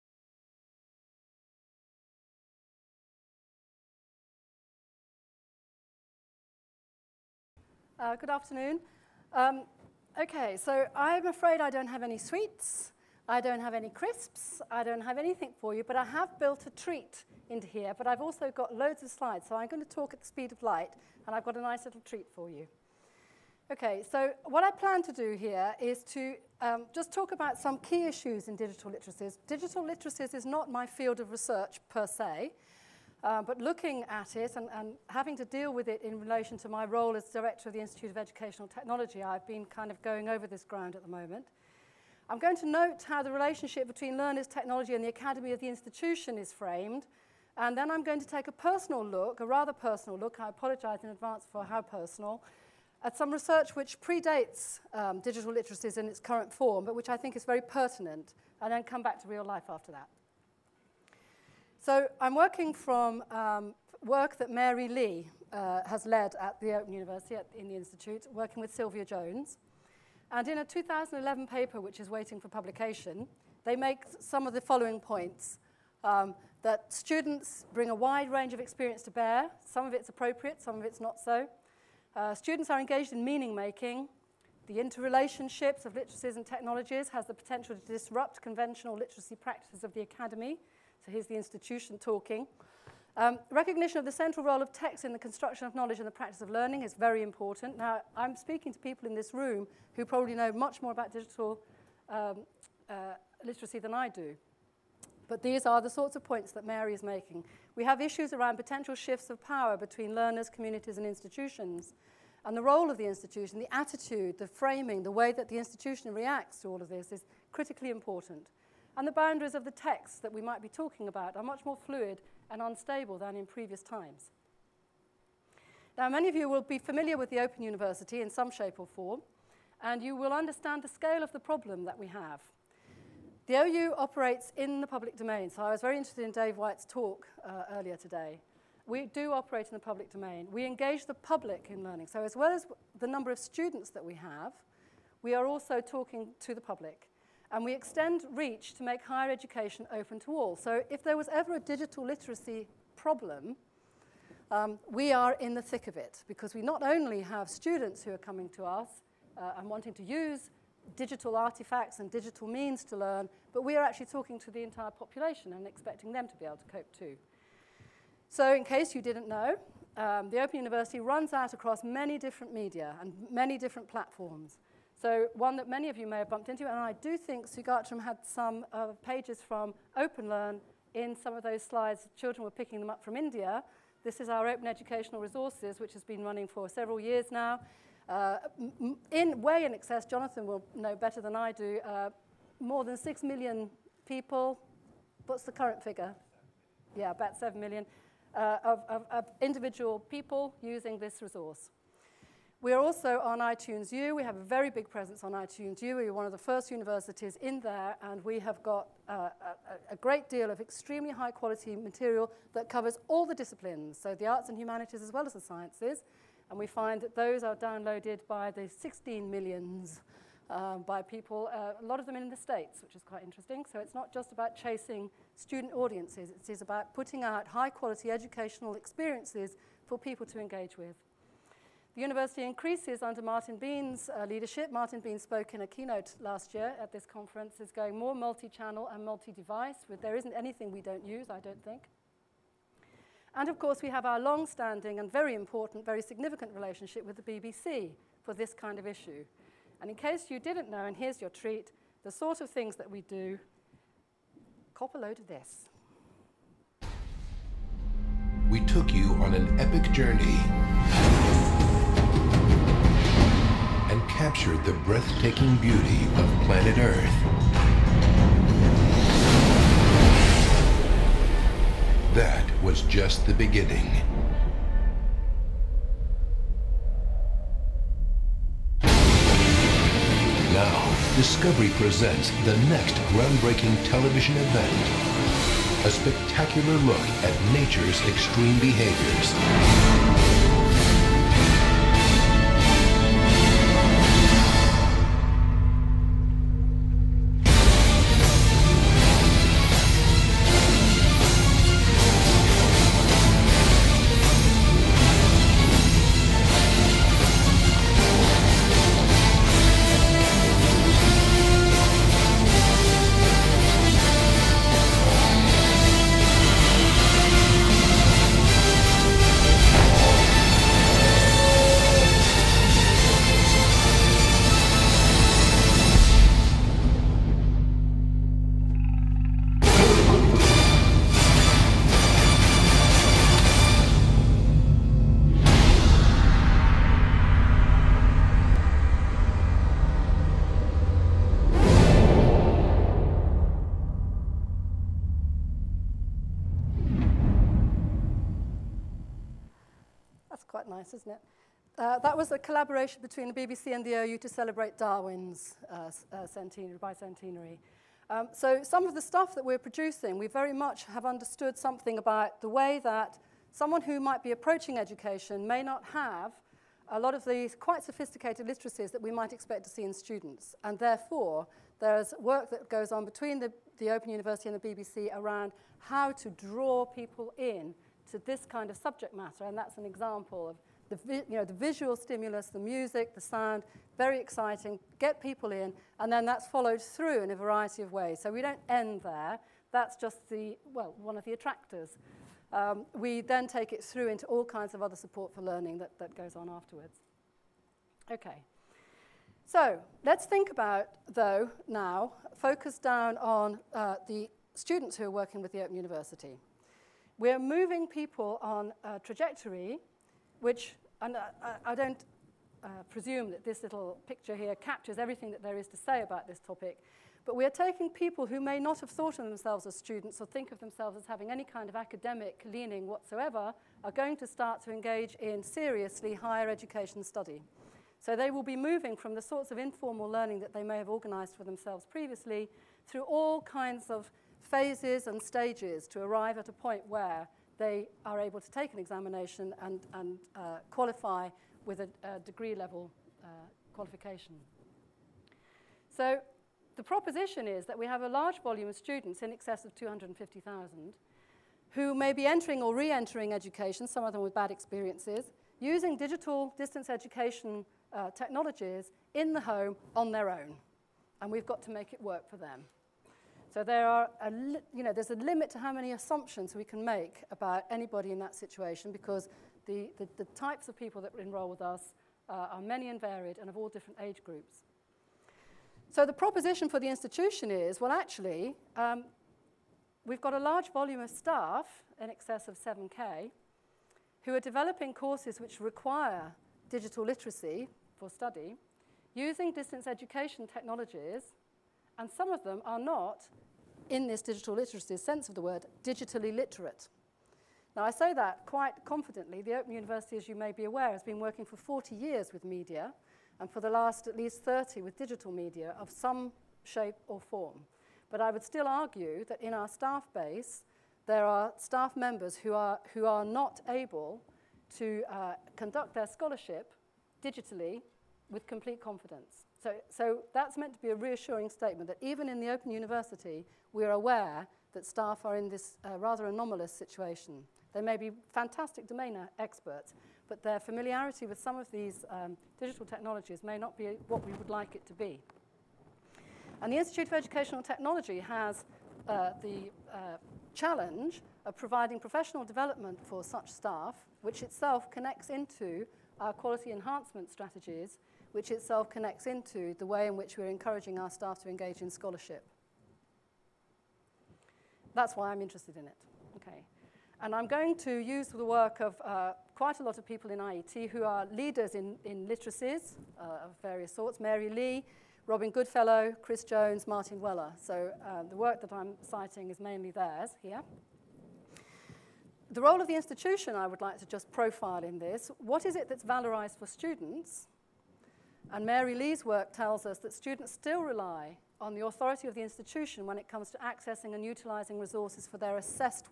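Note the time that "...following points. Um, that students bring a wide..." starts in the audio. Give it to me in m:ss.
1:14.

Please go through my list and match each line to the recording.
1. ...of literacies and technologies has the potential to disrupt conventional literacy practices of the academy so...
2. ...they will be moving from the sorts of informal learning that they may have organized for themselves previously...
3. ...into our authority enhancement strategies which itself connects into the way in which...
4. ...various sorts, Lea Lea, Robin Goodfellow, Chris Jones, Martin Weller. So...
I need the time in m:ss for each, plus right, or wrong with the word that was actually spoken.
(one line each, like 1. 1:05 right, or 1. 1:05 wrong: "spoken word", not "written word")
1. 1:25 right
2. 7:08 right
3. 9:05 wrong: "quality", not "authority"
4. 9:23 wrong: "Mary", not "Lea".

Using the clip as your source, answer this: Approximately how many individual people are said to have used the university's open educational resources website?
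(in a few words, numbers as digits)
7 million.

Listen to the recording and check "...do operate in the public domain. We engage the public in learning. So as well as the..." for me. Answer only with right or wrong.
right.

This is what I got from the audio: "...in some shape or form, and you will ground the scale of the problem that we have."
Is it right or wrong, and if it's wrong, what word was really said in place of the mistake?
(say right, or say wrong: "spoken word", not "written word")
wrong: "understand", not "ground".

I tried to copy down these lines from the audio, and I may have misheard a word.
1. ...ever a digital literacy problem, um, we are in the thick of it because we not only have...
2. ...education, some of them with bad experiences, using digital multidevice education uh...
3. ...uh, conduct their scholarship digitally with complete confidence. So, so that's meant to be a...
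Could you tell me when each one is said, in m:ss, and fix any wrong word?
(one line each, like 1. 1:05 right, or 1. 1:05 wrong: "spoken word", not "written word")
1. 2:31 right
2. 7:33 wrong: "distance", not "multidevice"
3. 8:35 right.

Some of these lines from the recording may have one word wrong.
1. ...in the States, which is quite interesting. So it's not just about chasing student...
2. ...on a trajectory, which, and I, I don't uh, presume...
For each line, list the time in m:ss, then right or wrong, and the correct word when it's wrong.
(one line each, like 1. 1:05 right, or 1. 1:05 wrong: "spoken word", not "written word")
1. 3:42 right
2. 6:48 right.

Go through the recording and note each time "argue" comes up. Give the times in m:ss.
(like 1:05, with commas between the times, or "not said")
8:28.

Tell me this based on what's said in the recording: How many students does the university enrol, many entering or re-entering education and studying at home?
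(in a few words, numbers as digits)
250,000.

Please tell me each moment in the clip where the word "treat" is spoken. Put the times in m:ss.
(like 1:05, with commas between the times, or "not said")
0:16, 0:22, 4:11.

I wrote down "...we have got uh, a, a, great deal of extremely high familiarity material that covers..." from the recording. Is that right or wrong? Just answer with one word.
wrong.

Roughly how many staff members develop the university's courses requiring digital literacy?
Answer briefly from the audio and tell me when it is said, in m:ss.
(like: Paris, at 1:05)
7,000, at 8:02.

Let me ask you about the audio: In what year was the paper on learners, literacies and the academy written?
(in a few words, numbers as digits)
2011.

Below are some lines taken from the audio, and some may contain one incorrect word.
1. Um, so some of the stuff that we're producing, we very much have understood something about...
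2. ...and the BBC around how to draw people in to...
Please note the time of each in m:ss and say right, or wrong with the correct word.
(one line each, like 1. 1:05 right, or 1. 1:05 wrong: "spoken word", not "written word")
1. 5:58 right
2. 6:14 right.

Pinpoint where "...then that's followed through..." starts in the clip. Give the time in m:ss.
6:26.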